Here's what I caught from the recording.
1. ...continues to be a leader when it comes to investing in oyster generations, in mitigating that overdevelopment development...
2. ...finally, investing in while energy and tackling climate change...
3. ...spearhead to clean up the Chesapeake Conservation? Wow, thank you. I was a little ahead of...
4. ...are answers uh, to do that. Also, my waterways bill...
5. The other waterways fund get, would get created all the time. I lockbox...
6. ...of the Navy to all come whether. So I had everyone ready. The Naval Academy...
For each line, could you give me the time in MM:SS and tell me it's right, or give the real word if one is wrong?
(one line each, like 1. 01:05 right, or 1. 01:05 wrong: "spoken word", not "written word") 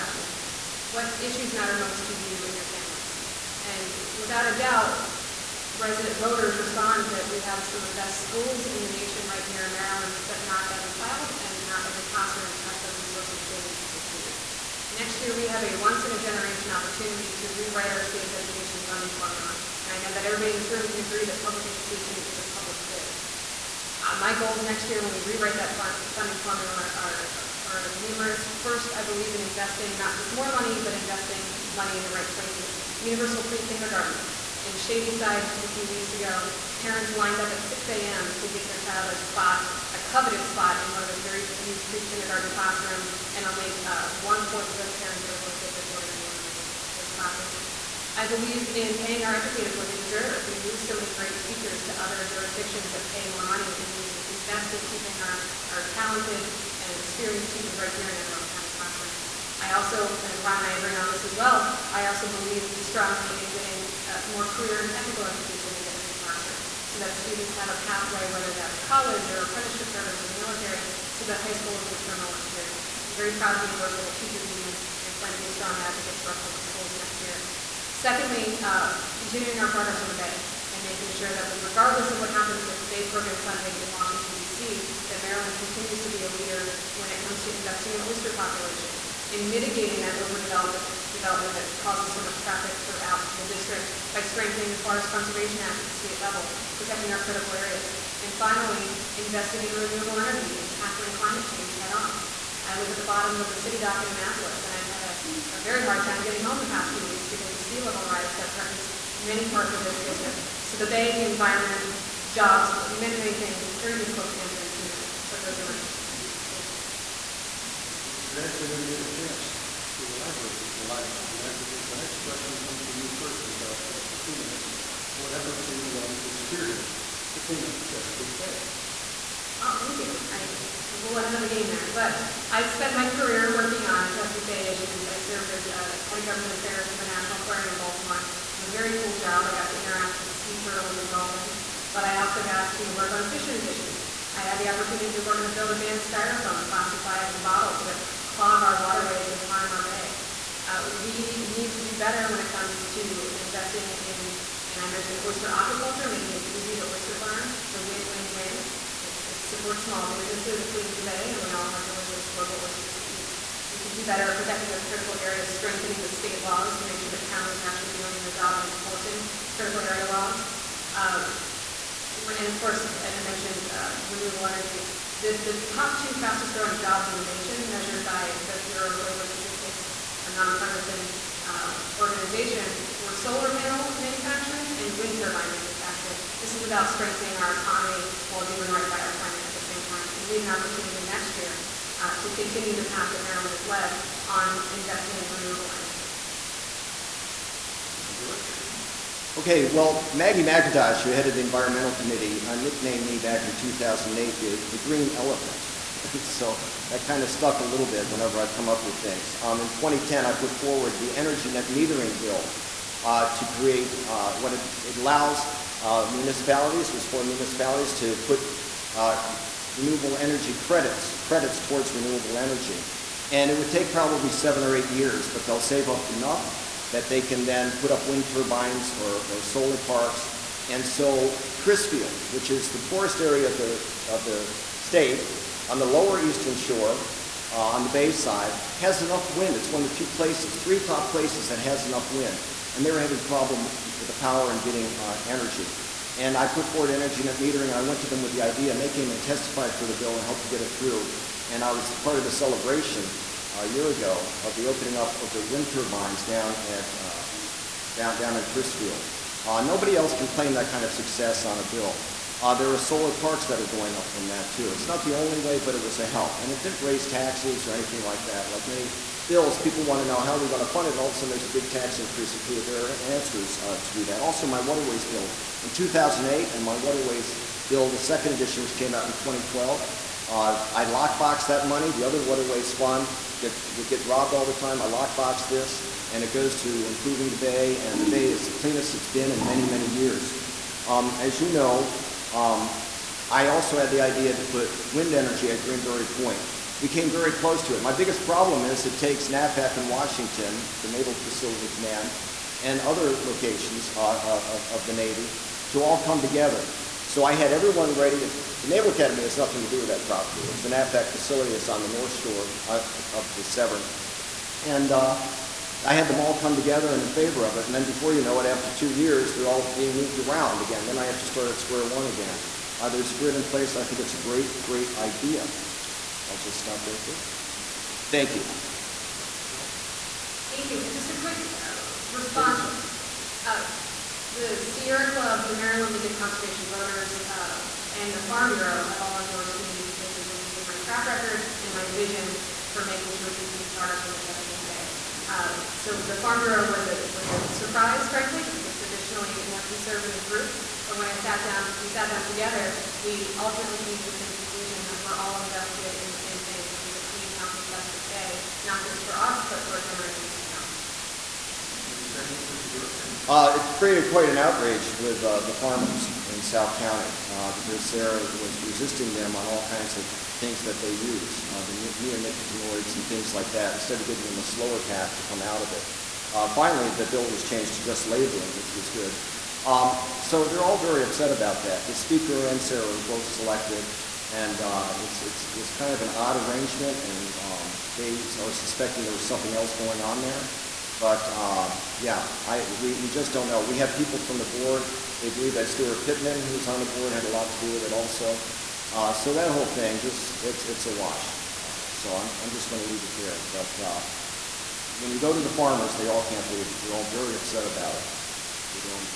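1. 01:25 wrong: "populations", not "generations"
2. 01:38 wrong: "renewable", not "while"
3. 02:06 wrong: "Bay", not "Conservation"
4. 04:32 right
5. 04:41 wrong: "robbed", not "created"
6. 05:04 wrong: "together", not "whether".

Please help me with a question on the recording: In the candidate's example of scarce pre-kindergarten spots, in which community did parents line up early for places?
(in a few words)
Shadyside.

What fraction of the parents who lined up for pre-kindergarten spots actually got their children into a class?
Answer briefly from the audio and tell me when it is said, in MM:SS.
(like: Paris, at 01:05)
one-fourth, at 00:44.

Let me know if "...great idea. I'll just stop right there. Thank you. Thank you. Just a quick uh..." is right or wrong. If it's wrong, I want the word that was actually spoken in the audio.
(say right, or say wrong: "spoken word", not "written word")
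right.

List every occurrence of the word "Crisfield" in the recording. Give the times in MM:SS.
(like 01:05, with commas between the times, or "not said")
03:51, 04:18.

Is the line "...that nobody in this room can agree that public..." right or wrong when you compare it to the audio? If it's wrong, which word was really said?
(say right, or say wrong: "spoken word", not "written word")
wrong: "everybody", not "nobody".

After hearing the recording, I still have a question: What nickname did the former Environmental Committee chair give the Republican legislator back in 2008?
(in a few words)
the Green Elephant.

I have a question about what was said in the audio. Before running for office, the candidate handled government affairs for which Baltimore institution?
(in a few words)
National Aquarium.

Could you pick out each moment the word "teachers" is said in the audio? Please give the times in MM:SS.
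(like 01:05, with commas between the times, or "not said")
00:51, 00:57, 01:14.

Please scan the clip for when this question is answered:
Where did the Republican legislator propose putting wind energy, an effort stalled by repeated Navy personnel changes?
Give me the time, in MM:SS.
04:55.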